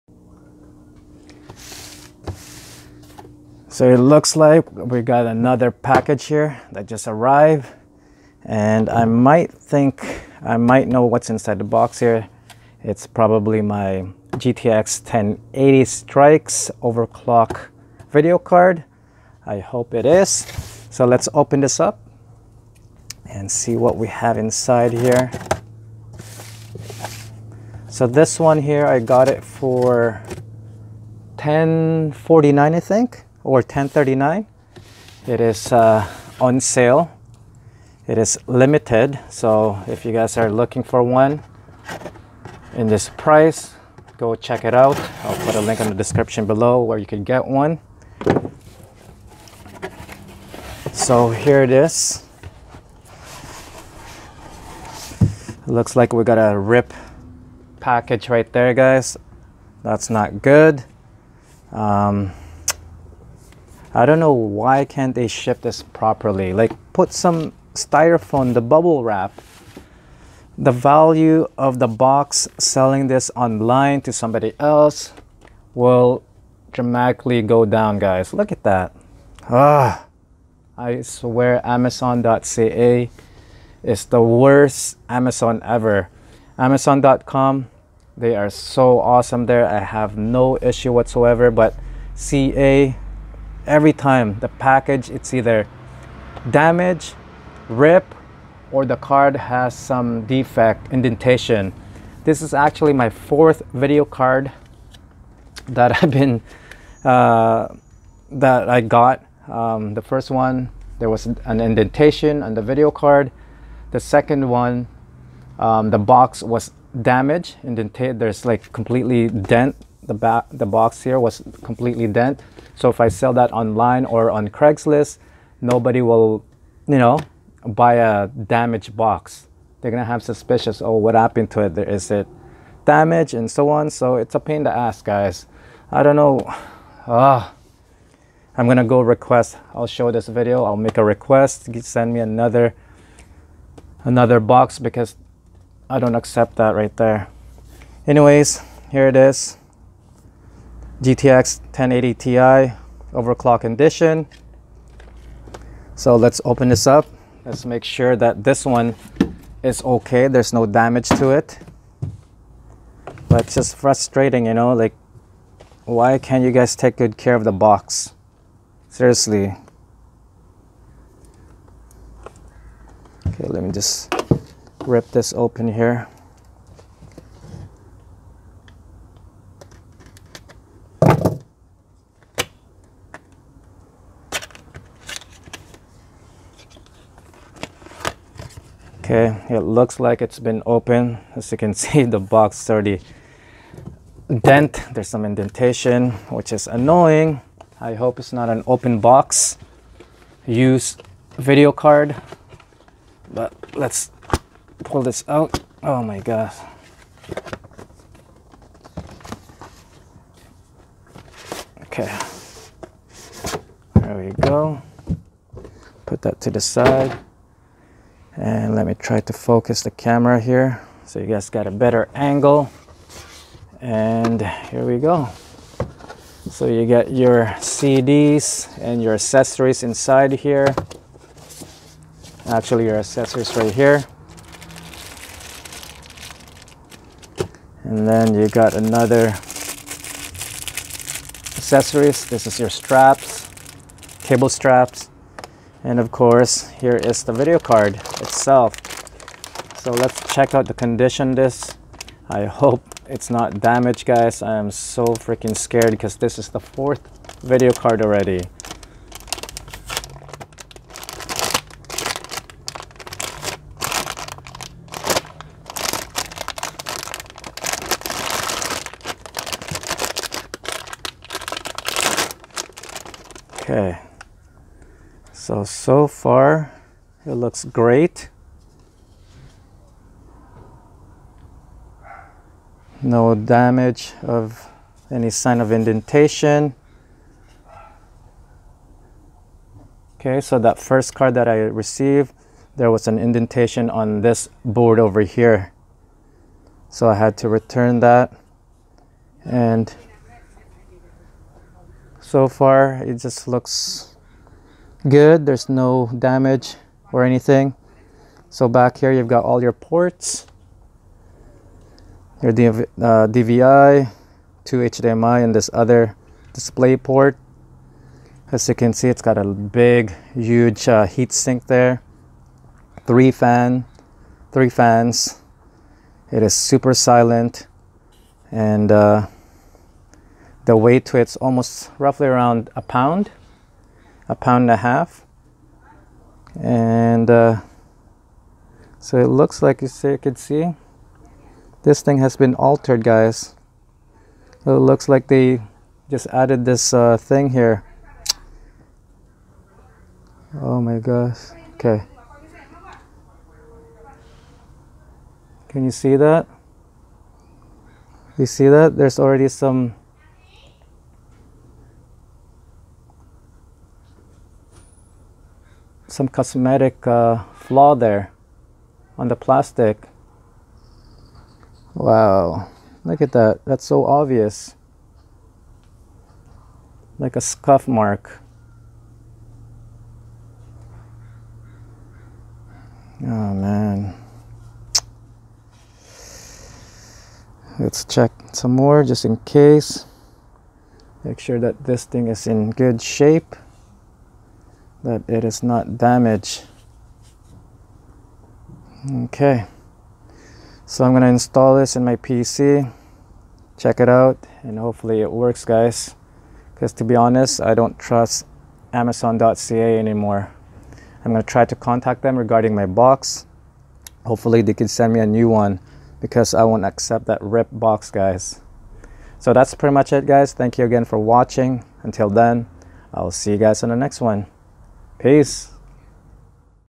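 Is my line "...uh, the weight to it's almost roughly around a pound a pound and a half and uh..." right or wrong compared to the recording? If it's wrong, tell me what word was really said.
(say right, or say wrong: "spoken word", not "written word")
right.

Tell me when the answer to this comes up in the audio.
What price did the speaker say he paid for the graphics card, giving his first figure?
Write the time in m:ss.
0:31.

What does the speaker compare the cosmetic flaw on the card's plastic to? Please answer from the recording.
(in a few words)
a scuff mark.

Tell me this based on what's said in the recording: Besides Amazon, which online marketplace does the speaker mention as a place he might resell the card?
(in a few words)
Craigslist.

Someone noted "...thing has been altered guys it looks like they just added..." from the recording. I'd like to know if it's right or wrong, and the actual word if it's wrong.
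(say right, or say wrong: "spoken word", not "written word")
right.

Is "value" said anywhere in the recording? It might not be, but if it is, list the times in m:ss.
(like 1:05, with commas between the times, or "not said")
1:10.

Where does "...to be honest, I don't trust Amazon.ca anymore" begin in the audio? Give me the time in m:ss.
6:46.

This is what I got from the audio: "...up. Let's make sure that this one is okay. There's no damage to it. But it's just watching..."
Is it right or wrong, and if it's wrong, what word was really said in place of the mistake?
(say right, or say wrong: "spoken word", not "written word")
wrong: "frustrating", not "watching".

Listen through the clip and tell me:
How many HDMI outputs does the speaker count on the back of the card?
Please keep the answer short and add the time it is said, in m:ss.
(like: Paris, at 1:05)
2, at 5:14.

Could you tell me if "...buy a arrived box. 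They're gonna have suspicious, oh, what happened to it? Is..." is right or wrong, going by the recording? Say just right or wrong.
wrong.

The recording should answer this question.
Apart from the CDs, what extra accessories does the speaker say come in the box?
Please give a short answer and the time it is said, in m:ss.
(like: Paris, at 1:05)
cable straps, at 4:04.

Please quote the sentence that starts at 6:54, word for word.
Hopefully they can send me a new one because I won't accept that rip box, guys.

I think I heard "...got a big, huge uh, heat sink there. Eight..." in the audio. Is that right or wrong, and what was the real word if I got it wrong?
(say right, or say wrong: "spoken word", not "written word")
wrong: "Three", not "Eight".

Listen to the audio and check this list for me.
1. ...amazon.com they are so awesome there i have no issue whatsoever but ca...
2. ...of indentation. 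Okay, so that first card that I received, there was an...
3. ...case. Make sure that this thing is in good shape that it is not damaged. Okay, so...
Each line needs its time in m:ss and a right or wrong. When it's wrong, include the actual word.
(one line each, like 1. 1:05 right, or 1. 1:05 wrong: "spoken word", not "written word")
1. 1:26 right
2. 4:45 right
3. 6:29 right.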